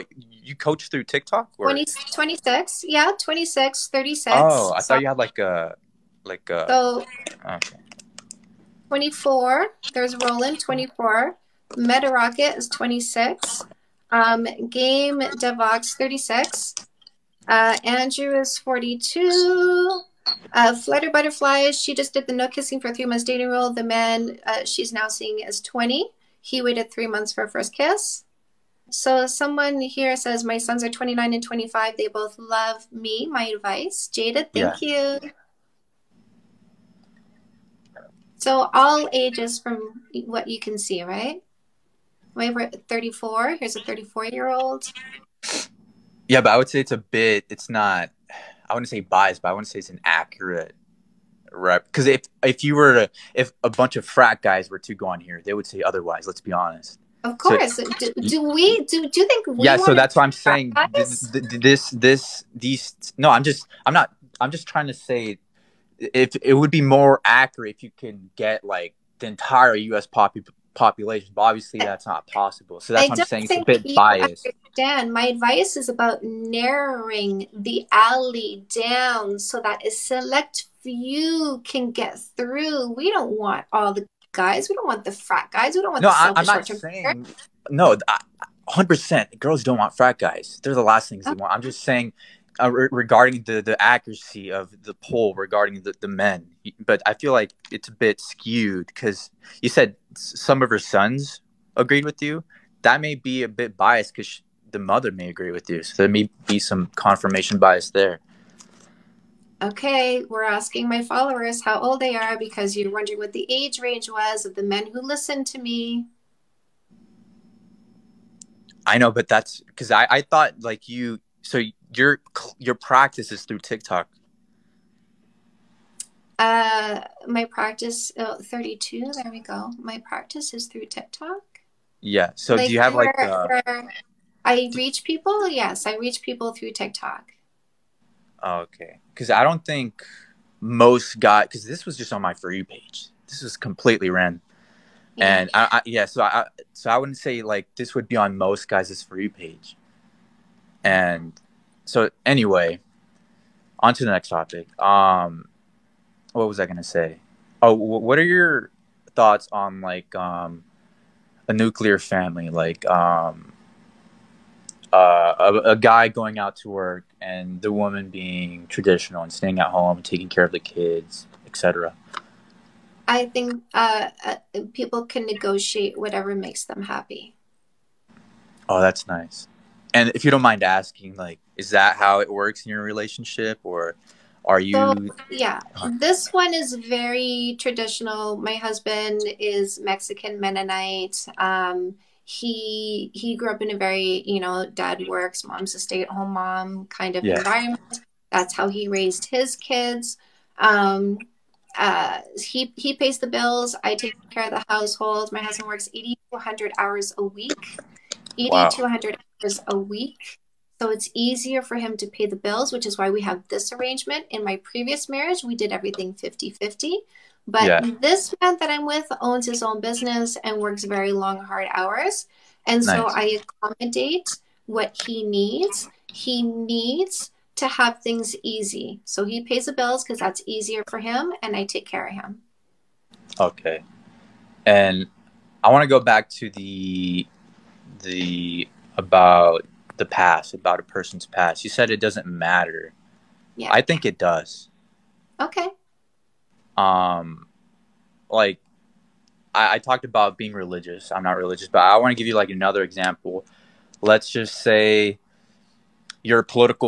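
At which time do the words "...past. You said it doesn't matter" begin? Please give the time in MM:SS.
04:01.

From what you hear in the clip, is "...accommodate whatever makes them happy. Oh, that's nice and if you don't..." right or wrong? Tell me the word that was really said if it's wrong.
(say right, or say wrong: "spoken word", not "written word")
wrong: "negotiate", not "accommodate".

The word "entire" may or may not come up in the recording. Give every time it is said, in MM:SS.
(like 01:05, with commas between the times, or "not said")
01:09.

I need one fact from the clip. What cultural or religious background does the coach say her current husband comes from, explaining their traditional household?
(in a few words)
Mexican Mennonite.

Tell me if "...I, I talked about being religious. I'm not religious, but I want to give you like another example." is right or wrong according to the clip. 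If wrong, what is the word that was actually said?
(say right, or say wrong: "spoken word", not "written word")
right.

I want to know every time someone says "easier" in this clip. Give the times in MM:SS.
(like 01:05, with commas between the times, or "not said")
03:31, 03:50.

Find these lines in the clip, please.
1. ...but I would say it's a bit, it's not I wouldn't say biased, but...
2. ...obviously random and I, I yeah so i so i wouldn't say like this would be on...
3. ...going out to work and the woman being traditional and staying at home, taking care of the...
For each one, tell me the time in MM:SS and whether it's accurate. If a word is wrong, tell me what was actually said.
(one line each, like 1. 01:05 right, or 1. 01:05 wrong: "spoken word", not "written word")
1. 00:46 right
2. 02:23 wrong: "completely", not "obviously"
3. 02:46 right.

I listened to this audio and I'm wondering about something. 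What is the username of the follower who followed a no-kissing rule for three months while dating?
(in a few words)
Flutter Butterflies.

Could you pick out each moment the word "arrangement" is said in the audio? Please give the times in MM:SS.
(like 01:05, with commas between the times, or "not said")
03:33.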